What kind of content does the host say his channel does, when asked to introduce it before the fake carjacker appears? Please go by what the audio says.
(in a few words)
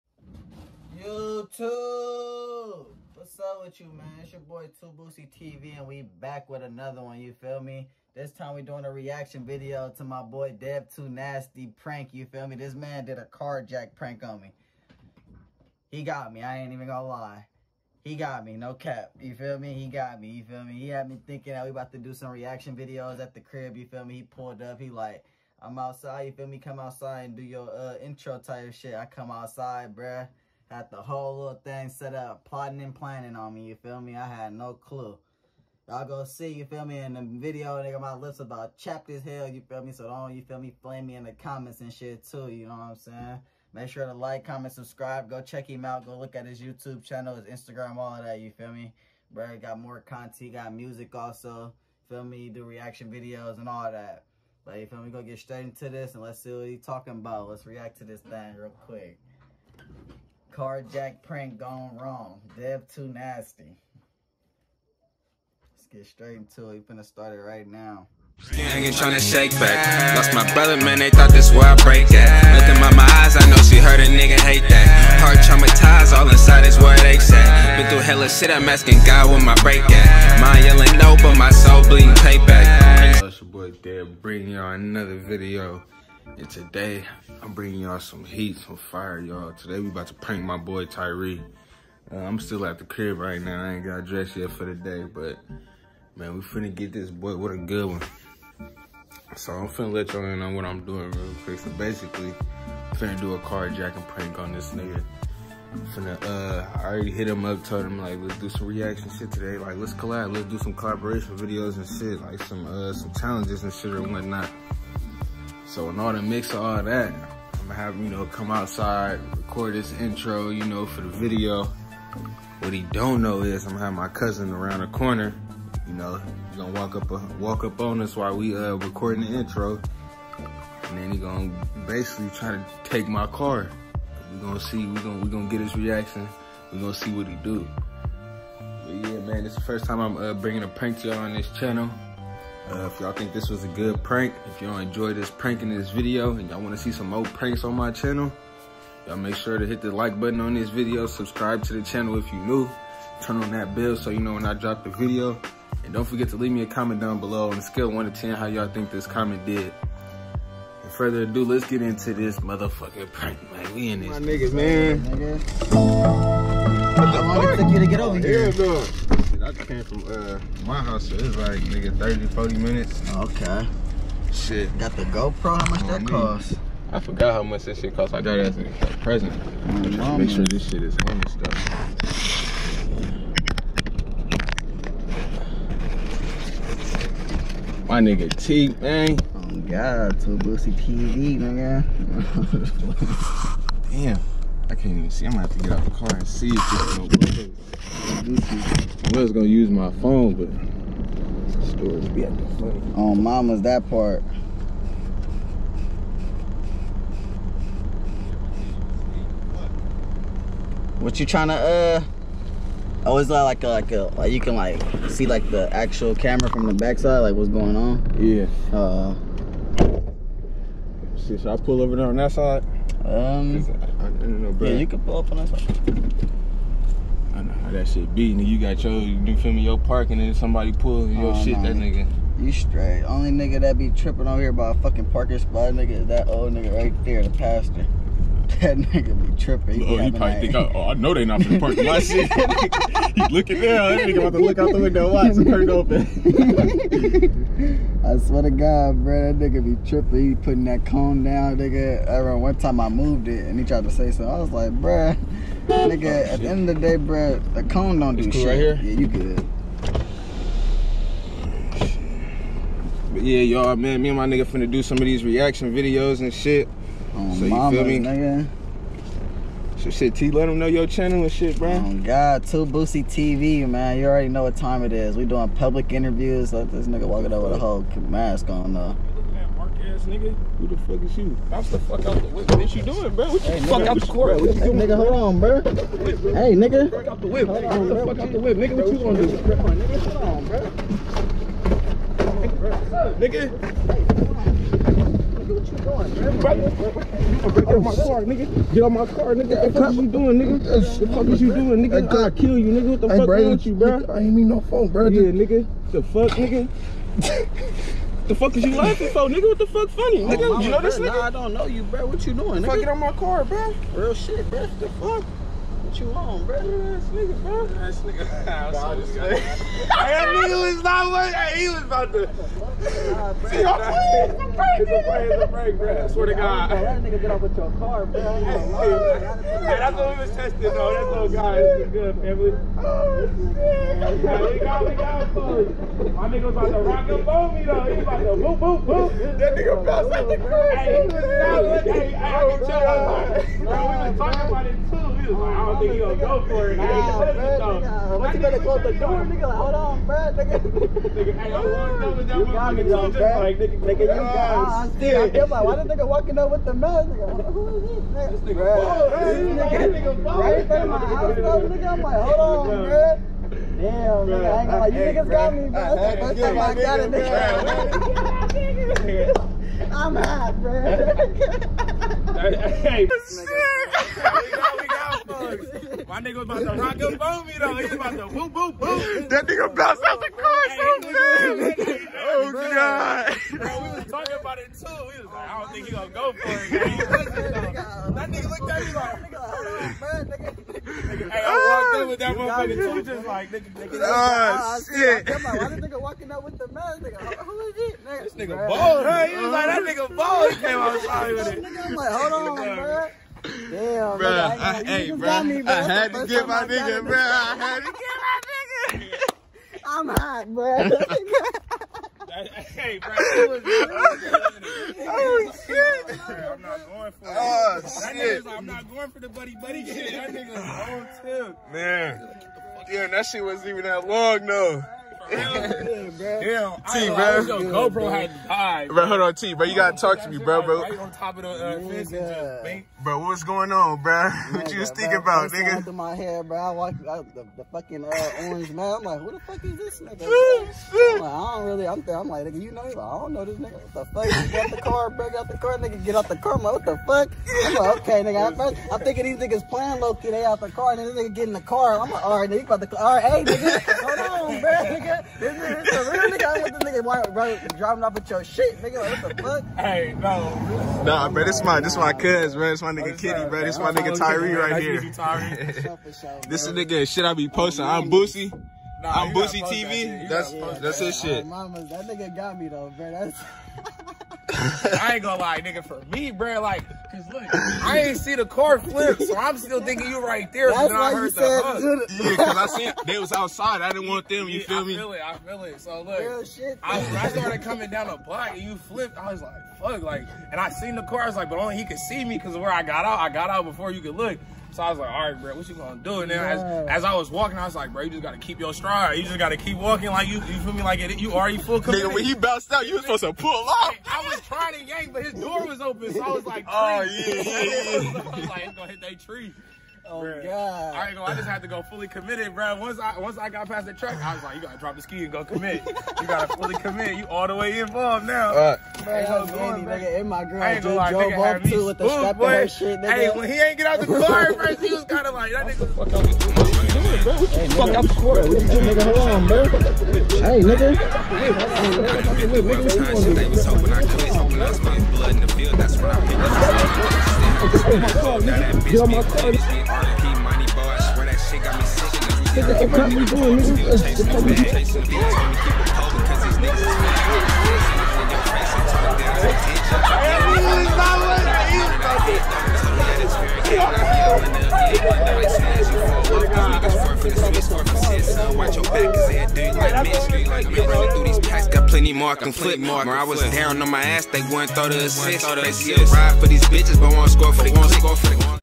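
Public interviews.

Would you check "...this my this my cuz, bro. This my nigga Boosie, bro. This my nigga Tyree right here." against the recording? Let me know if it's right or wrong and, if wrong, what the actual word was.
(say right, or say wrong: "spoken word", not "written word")
wrong: "Kitty", not "Boosie".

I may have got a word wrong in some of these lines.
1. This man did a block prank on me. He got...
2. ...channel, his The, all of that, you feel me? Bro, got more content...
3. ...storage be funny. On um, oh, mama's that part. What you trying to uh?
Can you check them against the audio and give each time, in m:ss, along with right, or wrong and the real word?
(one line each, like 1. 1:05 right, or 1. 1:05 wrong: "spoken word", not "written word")
1. 0:12 wrong: "carjack", not "block"
2. 0:47 wrong: "Instagram", not "The"
3. 3:21 right.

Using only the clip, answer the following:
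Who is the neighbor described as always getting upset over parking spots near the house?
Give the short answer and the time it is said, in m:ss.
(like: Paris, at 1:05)
The pastor, at 3:57.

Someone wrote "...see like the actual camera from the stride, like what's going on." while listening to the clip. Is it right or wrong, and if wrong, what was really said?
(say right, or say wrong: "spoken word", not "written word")
wrong: "backside", not "stride".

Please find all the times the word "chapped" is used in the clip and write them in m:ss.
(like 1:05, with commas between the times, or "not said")
0:38.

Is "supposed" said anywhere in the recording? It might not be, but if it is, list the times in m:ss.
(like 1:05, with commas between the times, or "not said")
8:23.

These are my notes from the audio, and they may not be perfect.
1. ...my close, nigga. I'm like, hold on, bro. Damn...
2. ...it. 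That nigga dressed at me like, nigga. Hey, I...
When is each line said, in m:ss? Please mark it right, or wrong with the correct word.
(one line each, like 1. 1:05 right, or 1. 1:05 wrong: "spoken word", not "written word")
1. 6:00 wrong: "house", not "close"
2. 6:26 wrong: "looked", not "dressed".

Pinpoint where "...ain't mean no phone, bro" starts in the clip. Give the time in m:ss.
5:04.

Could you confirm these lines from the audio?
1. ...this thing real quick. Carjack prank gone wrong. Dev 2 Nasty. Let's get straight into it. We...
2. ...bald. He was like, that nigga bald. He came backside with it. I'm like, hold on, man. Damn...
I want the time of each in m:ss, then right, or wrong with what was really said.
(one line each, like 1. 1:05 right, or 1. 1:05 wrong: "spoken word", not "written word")
1. 0:58 right
2. 6:38 wrong: "outside", not "backside".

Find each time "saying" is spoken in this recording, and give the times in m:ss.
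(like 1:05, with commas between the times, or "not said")
0:42.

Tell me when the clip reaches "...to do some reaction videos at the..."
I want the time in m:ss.
0:21.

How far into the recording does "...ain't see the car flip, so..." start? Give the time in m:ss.
7:57.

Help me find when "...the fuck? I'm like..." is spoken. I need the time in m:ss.
7:26.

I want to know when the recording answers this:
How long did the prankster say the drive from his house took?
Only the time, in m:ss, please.
2:51.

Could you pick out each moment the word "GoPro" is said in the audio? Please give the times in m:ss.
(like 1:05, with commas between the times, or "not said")
2:55, 7:07.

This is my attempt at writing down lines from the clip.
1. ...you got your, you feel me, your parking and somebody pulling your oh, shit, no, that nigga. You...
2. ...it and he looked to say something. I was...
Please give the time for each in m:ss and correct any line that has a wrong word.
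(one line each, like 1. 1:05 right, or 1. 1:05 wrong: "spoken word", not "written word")
1. 3:48 right
2. 4:13 wrong: "tried", not "looked".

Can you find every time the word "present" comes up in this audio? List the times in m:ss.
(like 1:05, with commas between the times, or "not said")
2:58.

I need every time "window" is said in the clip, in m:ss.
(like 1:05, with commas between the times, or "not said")
4:04.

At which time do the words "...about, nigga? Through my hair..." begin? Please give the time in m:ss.
7:15.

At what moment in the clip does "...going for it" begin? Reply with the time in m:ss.
6:56.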